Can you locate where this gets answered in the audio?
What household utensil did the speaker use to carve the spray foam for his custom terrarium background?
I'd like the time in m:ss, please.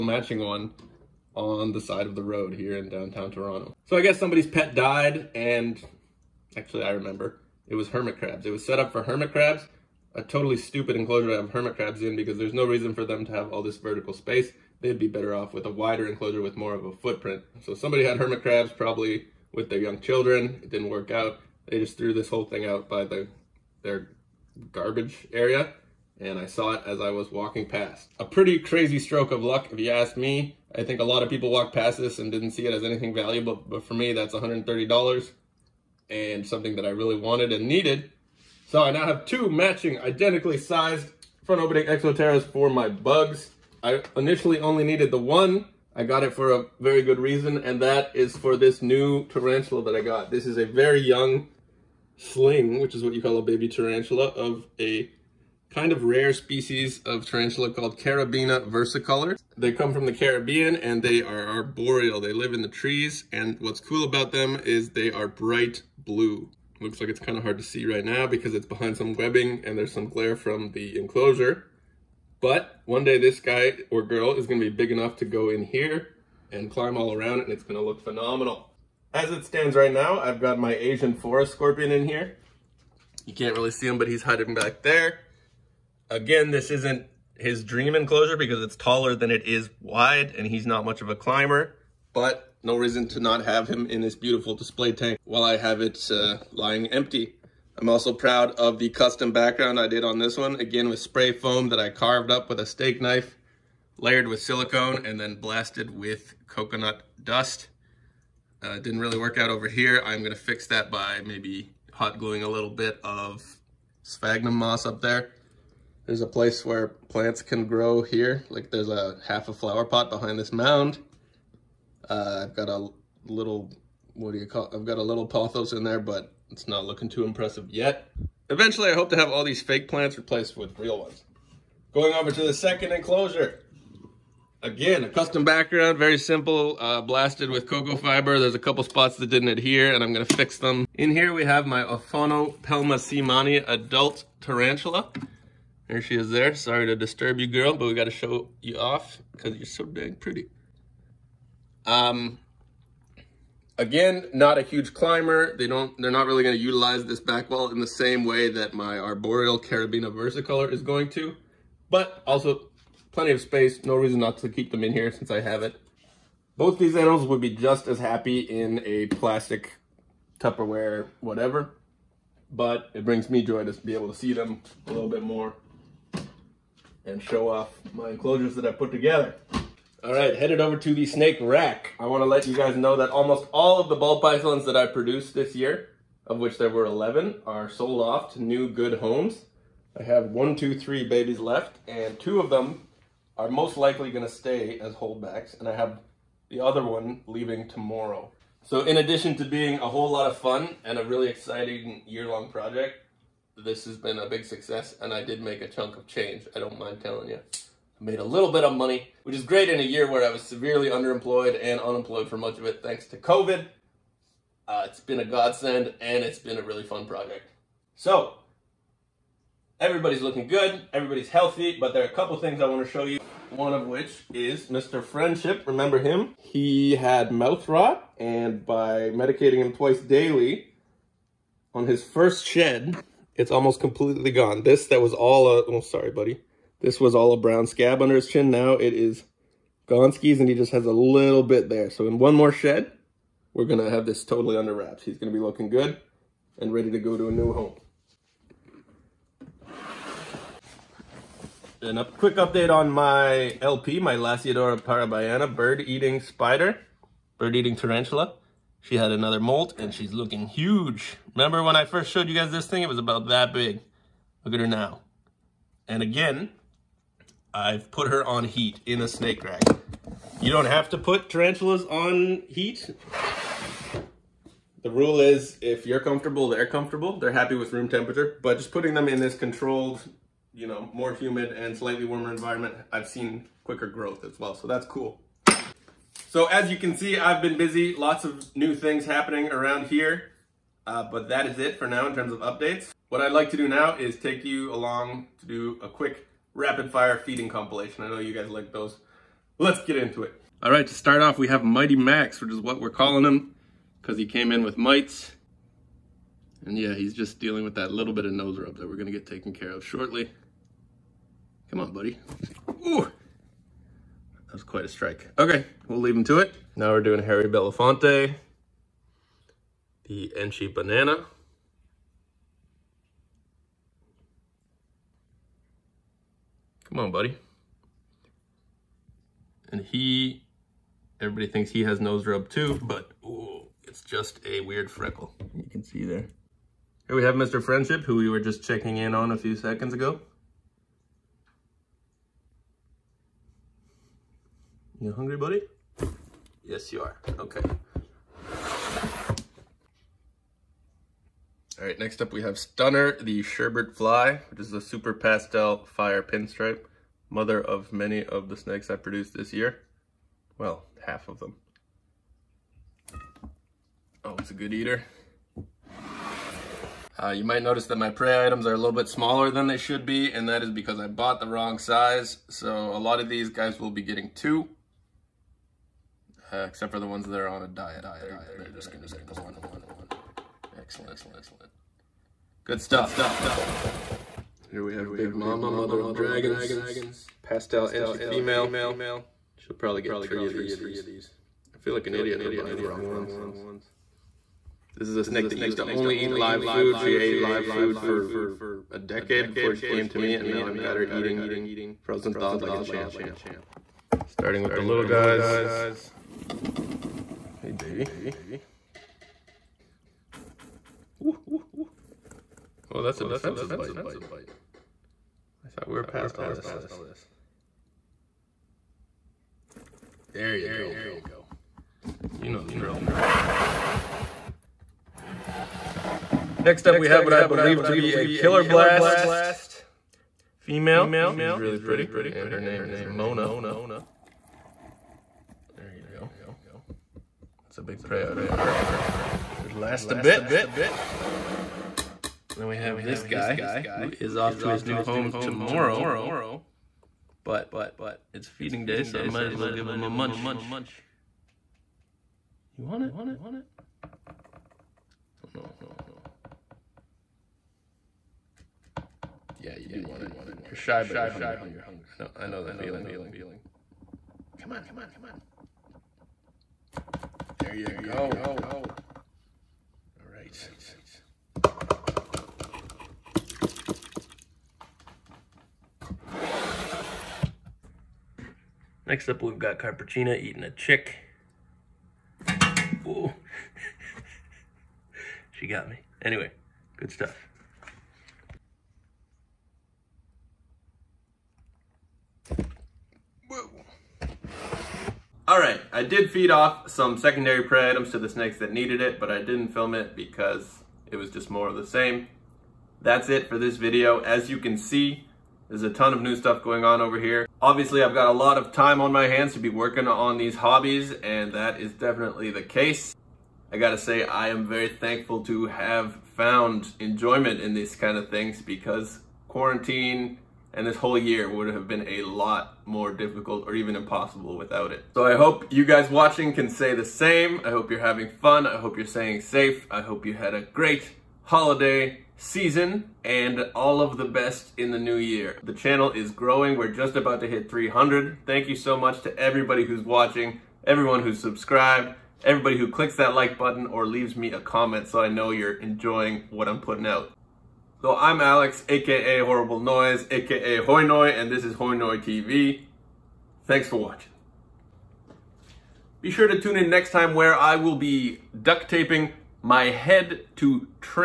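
1:42.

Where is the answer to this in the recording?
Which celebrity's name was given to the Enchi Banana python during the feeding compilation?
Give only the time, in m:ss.
5:17.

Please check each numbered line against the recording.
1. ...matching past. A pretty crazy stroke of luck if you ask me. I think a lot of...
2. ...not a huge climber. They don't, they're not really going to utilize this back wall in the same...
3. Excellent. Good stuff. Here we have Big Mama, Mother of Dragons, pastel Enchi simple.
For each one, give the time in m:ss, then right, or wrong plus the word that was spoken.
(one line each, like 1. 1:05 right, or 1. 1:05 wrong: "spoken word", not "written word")
1. 0:27 wrong: "walking", not "matching"
2. 2:34 right
3. 6:20 wrong: "female", not "simple".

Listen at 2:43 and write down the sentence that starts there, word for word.
No reason not to keep them in here since I have it.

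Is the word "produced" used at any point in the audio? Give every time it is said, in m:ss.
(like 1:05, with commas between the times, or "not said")
3:04, 5:58.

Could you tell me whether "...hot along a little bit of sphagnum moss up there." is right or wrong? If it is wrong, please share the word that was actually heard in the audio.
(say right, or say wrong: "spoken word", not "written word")
wrong: "gluing", not "along".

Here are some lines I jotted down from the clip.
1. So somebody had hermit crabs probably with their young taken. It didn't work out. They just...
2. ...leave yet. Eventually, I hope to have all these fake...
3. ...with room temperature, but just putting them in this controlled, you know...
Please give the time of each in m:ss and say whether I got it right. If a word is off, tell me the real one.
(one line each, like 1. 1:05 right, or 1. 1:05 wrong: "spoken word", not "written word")
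1. 0:17 wrong: "children", not "taken"
2. 2:07 wrong: "impressive", not "leave"
3. 4:37 right.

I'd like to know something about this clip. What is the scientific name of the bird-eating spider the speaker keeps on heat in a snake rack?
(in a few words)
Lasiodora parahybana.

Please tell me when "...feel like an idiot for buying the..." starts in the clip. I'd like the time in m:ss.
6:31.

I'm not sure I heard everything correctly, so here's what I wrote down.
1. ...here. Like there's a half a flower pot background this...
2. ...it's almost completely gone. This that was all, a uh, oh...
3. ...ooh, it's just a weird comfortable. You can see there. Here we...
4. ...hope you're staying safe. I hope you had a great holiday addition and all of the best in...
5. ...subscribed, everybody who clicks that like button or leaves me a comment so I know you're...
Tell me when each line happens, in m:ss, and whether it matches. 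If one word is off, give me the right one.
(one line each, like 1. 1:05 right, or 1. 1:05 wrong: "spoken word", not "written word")
1. 1:58 wrong: "behind", not "background"
2. 3:53 right
3. 5:33 wrong: "freckle", not "comfortable"
4. 8:48 wrong: "season", not "addition"
5. 9:01 right.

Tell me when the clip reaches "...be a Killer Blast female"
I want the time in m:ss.
7:07.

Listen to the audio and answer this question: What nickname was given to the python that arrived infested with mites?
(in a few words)
Mighty Max.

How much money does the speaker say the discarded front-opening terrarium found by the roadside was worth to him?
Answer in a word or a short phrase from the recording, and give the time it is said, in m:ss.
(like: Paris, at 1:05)
$130, at 0:34.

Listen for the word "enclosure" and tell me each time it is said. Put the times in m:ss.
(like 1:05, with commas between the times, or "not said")
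0:10, 0:16, 1:10, 1:27, 2:12, 2:58.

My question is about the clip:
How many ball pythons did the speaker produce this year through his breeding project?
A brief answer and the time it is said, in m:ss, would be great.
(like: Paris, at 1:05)
11, at 3:06.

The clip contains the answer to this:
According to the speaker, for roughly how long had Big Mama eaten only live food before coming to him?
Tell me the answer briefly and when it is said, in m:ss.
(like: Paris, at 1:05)
a decade, at 6:38.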